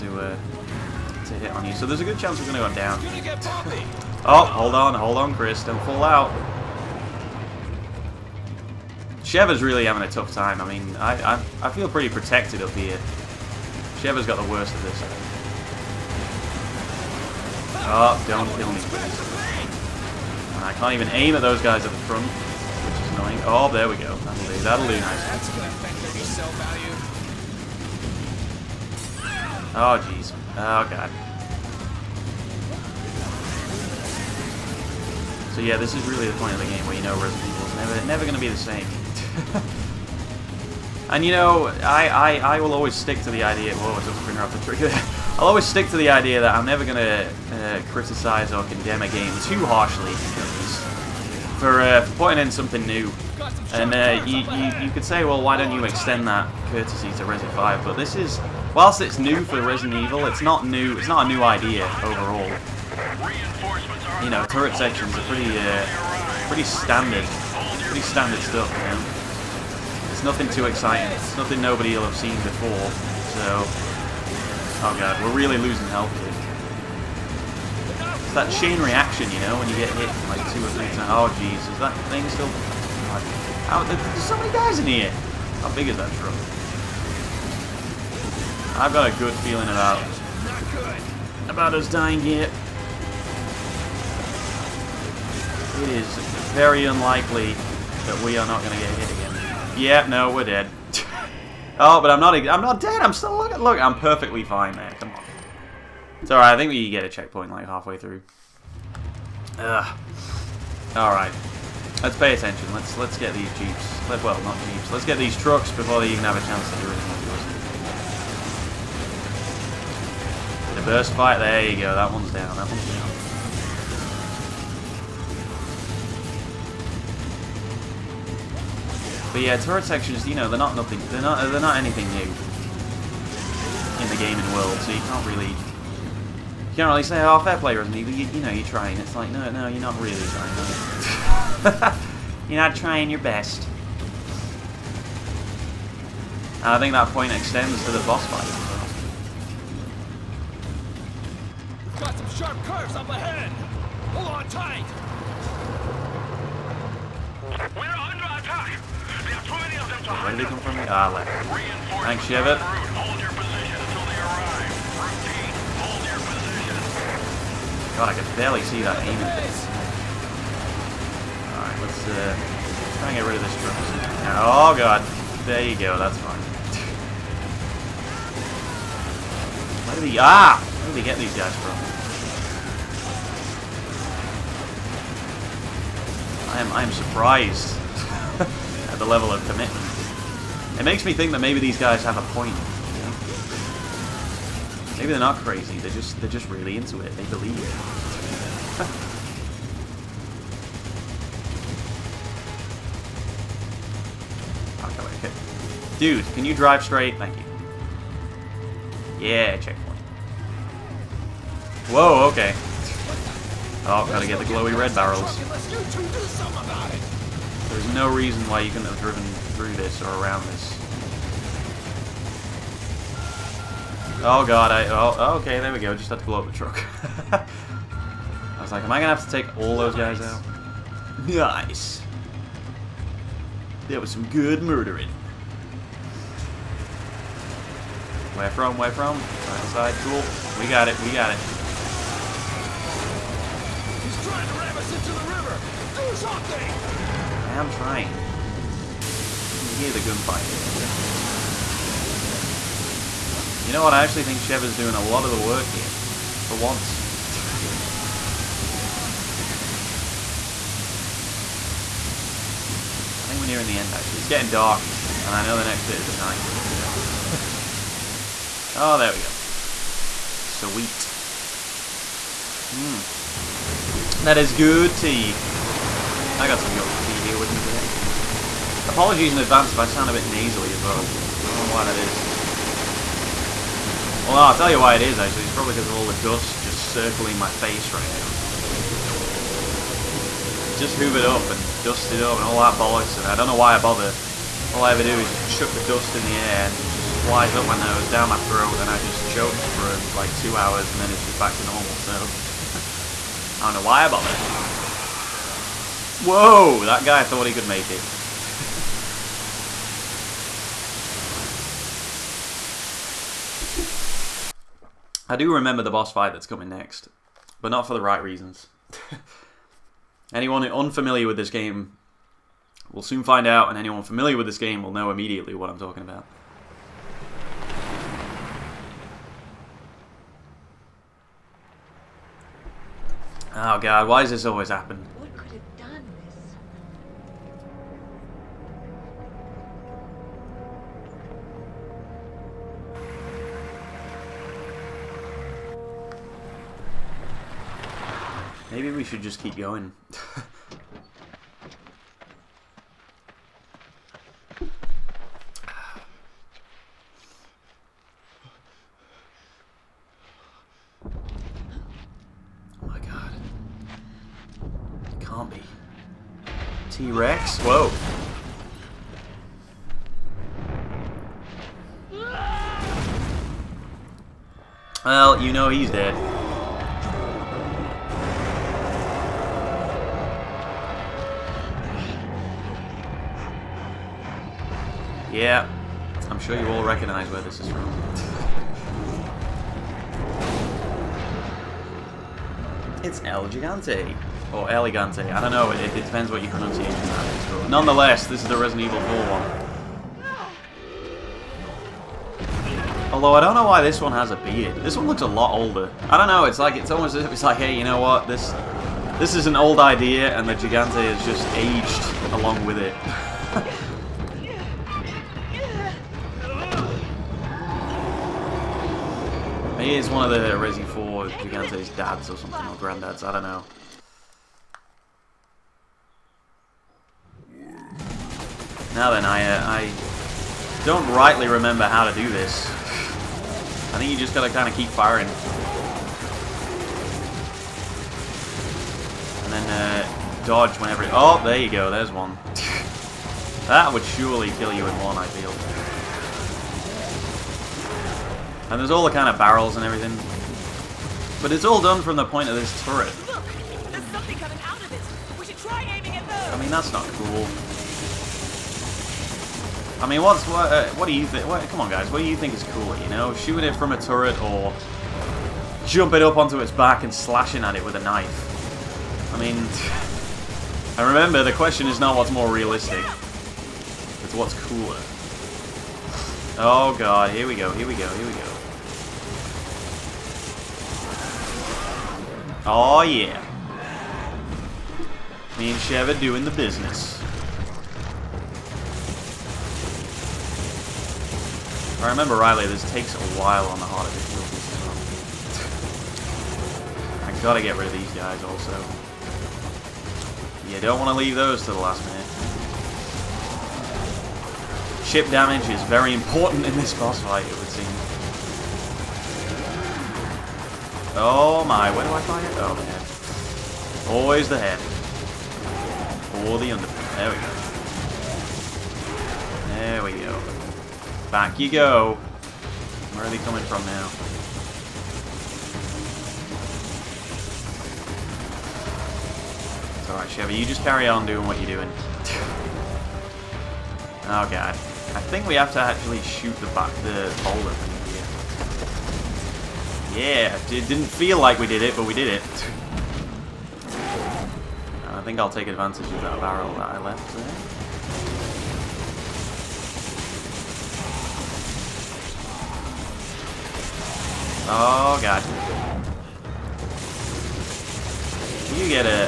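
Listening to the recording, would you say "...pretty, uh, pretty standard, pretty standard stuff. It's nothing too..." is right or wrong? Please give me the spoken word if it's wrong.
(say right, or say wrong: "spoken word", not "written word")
right.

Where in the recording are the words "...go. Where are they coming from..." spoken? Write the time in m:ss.
8:41.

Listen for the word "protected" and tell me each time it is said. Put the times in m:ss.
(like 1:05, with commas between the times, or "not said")
0:12.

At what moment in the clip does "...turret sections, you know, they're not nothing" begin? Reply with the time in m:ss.
2:09.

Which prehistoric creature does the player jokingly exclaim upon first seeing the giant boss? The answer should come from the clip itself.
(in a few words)
T-Rex.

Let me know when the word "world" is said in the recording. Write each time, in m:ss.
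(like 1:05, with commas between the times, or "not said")
2:14.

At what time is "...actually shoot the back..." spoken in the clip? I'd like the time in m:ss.
8:55.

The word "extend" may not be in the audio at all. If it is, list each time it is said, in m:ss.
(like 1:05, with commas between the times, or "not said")
0:55, 2:27.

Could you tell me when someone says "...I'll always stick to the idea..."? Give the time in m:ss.
0:45.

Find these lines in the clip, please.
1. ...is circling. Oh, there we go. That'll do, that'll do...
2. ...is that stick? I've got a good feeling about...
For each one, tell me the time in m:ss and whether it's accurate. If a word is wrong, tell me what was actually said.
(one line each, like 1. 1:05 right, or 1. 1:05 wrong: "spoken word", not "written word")
1. 0:23 wrong: "annoying", not "circling"
2. 1:25 wrong: "truck", not "stick".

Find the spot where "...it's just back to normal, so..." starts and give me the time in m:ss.
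5:01.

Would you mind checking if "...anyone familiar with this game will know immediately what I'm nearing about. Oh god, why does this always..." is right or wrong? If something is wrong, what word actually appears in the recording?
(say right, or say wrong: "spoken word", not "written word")
wrong: "talking", not "nearing".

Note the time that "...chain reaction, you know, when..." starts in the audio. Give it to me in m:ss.
1:18.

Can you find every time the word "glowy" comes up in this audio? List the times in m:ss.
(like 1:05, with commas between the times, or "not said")
3:34.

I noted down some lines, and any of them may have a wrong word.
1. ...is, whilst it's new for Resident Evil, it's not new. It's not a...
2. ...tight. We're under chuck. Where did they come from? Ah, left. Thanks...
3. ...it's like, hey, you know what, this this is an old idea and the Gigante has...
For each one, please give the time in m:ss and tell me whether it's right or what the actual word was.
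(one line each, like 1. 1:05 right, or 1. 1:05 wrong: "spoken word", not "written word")
1. 0:58 right
2. 2:34 wrong: "attack", not "chuck"
3. 6:47 right.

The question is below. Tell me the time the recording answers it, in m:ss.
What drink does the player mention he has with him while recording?
4:36.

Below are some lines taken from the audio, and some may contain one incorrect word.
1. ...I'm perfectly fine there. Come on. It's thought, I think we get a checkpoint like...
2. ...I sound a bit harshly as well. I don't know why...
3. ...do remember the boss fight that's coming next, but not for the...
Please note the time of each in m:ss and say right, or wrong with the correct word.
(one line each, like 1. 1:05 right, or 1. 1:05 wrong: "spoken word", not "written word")
1. 1:43 wrong: "alright", not "thought"
2. 4:39 wrong: "nasally", not "harshly"
3. 5:15 right.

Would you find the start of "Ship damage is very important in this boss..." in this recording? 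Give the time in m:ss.
8:25.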